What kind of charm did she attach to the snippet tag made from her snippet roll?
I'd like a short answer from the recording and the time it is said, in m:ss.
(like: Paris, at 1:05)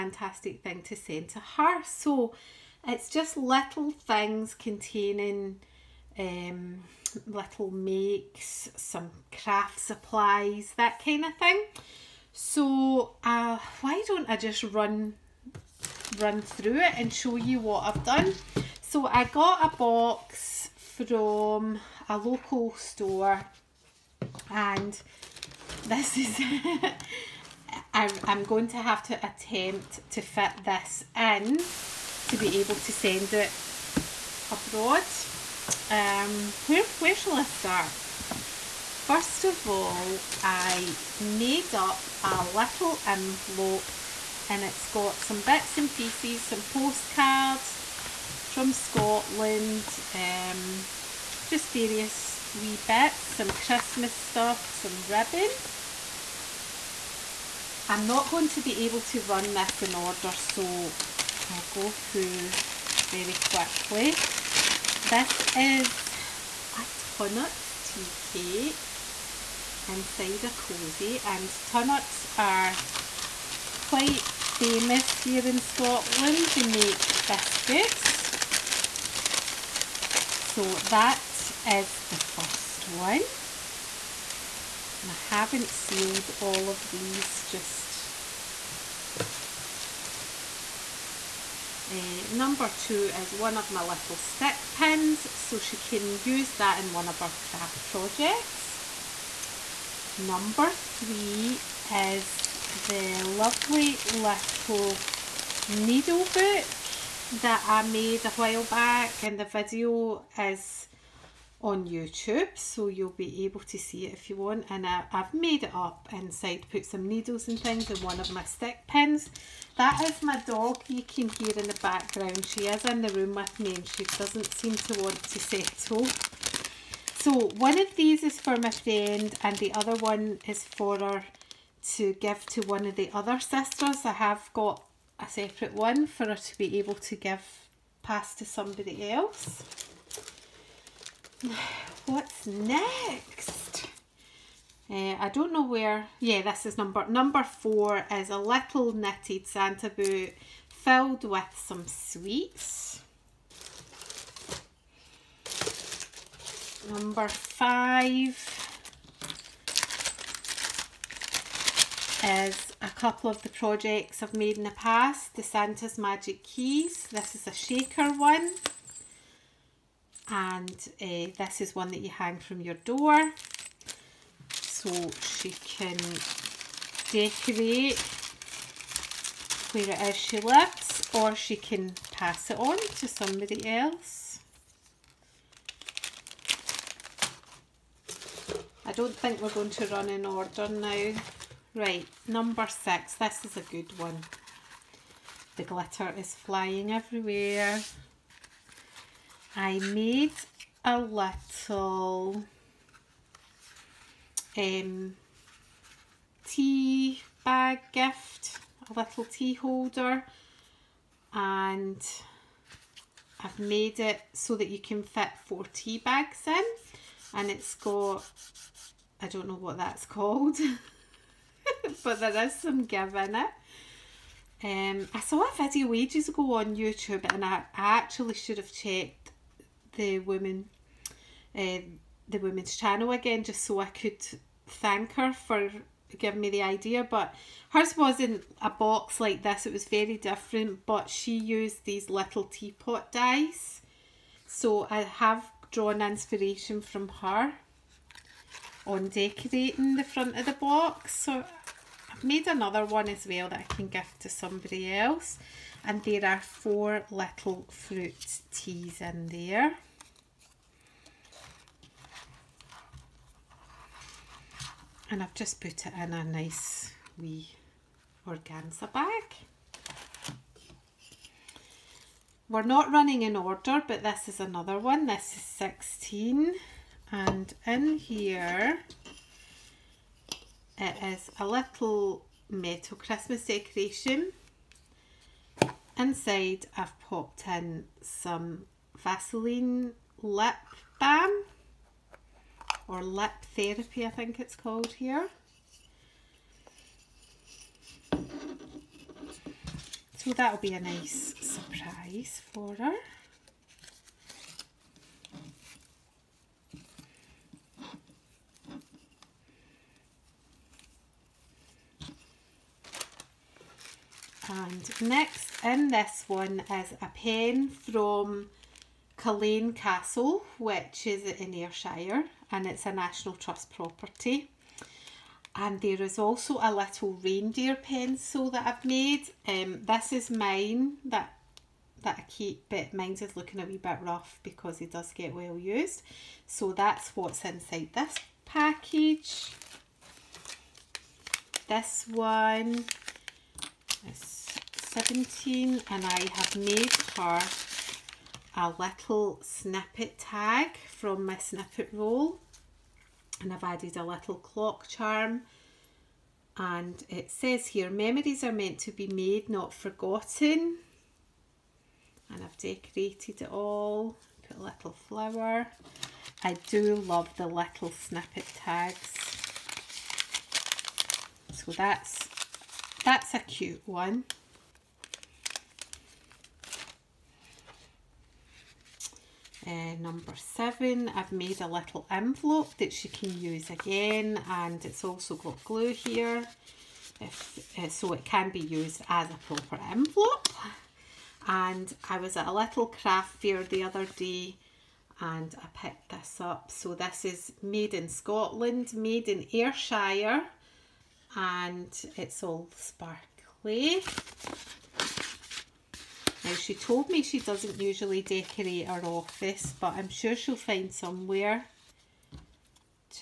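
clock charm, at 5:54.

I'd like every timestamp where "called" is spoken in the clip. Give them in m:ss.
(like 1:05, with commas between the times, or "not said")
3:40, 4:54.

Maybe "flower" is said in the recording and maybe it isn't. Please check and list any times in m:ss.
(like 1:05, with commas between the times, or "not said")
6:04.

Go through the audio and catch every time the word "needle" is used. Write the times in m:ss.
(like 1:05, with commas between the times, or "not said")
1:45, 1:57.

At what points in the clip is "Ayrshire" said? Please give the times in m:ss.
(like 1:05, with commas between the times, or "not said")
5:21, 6:39.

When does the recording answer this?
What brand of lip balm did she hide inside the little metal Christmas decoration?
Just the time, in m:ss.
4:48.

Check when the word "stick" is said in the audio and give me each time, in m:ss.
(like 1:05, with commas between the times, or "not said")
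1:34, 1:58.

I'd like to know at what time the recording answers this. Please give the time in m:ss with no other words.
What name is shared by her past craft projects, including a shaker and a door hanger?
2:45.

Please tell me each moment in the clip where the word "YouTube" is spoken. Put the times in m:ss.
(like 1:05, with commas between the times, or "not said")
1:51, 3:46.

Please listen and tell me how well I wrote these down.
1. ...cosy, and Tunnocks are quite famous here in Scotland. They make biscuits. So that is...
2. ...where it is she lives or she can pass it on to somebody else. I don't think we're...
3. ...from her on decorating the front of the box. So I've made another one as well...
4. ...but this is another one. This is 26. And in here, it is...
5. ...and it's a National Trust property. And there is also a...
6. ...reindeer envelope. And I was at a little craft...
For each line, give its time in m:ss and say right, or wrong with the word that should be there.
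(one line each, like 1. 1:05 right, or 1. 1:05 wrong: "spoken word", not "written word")
1. 1:10 right
2. 2:59 right
3. 4:06 right
4. 4:33 wrong: "16", not "26"
5. 5:22 right
6. 6:29 wrong: "proper", not "reindeer".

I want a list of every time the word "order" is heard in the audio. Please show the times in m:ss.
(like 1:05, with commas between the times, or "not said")
0:59, 3:10, 4:33.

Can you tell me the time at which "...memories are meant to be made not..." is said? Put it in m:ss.
5:57.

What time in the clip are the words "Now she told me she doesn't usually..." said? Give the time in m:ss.
6:46.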